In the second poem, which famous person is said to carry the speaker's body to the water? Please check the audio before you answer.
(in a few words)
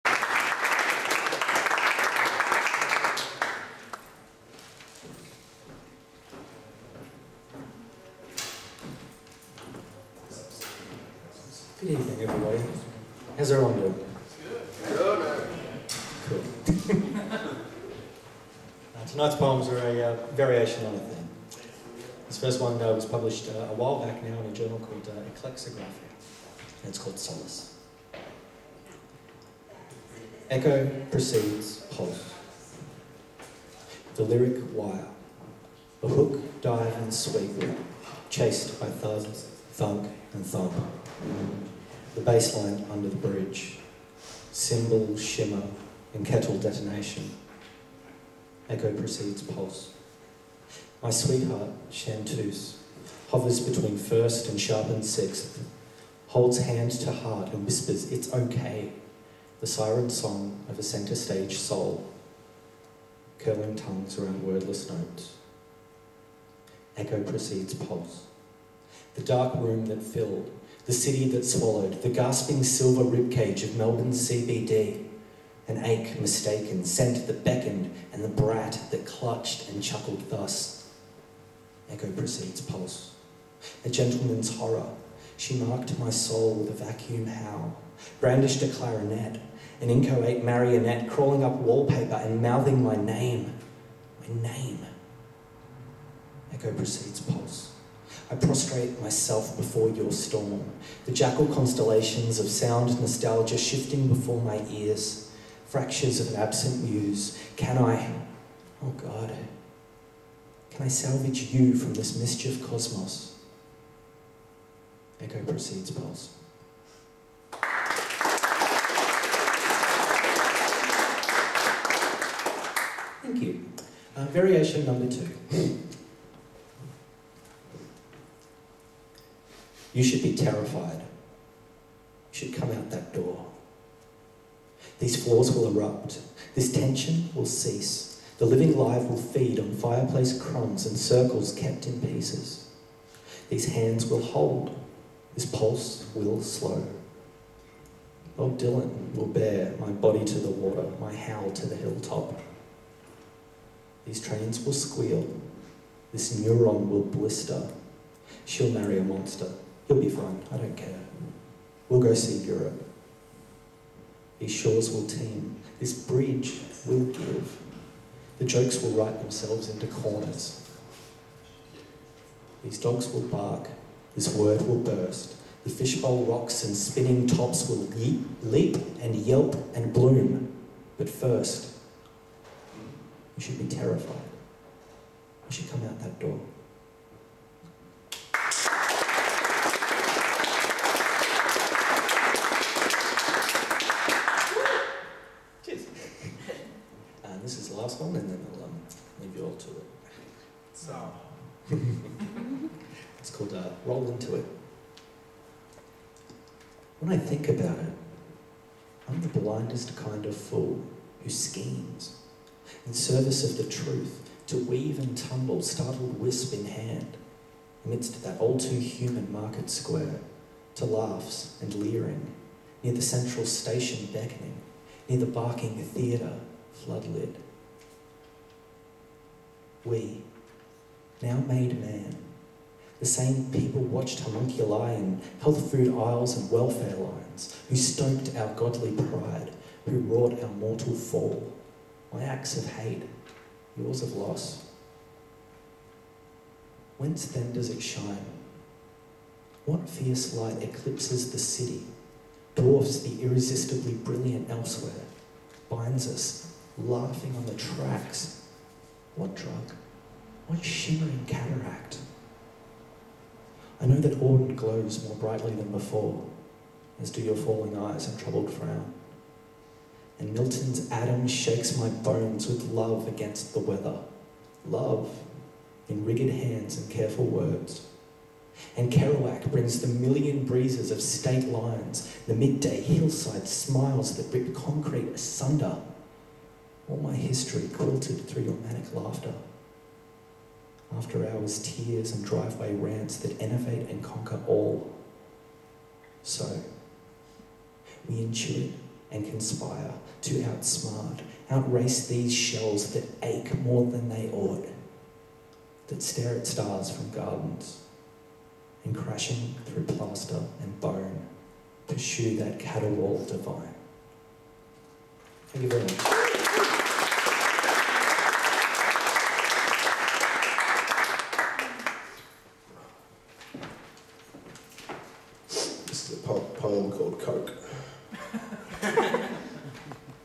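Bob Dylan.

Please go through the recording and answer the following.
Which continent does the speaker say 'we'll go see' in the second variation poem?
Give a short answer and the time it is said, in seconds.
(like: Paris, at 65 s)
Europe, at 162 s.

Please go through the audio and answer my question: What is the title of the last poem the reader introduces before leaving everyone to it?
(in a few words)
Roll Into It.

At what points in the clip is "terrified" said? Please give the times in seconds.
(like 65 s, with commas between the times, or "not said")
130 s, 183 s.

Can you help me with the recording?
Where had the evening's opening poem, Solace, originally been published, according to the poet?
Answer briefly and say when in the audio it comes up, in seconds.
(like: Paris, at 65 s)
Ekleksographia, at 25 s.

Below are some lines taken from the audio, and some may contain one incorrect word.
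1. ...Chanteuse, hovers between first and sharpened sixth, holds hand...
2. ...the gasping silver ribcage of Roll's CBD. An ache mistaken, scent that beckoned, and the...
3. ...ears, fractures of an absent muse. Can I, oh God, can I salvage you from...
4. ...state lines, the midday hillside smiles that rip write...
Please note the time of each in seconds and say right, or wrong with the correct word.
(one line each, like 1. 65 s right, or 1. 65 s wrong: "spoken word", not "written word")
1. 51 s right
2. 72 s wrong: "Melbourne", not "Roll"
3. 104 s right
4. 281 s wrong: "concrete", not "write".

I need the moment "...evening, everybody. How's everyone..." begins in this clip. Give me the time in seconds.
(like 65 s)
11 s.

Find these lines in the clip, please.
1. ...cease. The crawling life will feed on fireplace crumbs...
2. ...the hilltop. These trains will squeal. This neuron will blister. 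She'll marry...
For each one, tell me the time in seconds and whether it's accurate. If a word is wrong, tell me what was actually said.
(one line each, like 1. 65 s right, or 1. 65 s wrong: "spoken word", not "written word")
1. 137 s wrong: "living", not "crawling"
2. 151 s right.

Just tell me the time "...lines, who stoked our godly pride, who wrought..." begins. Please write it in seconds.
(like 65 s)
236 s.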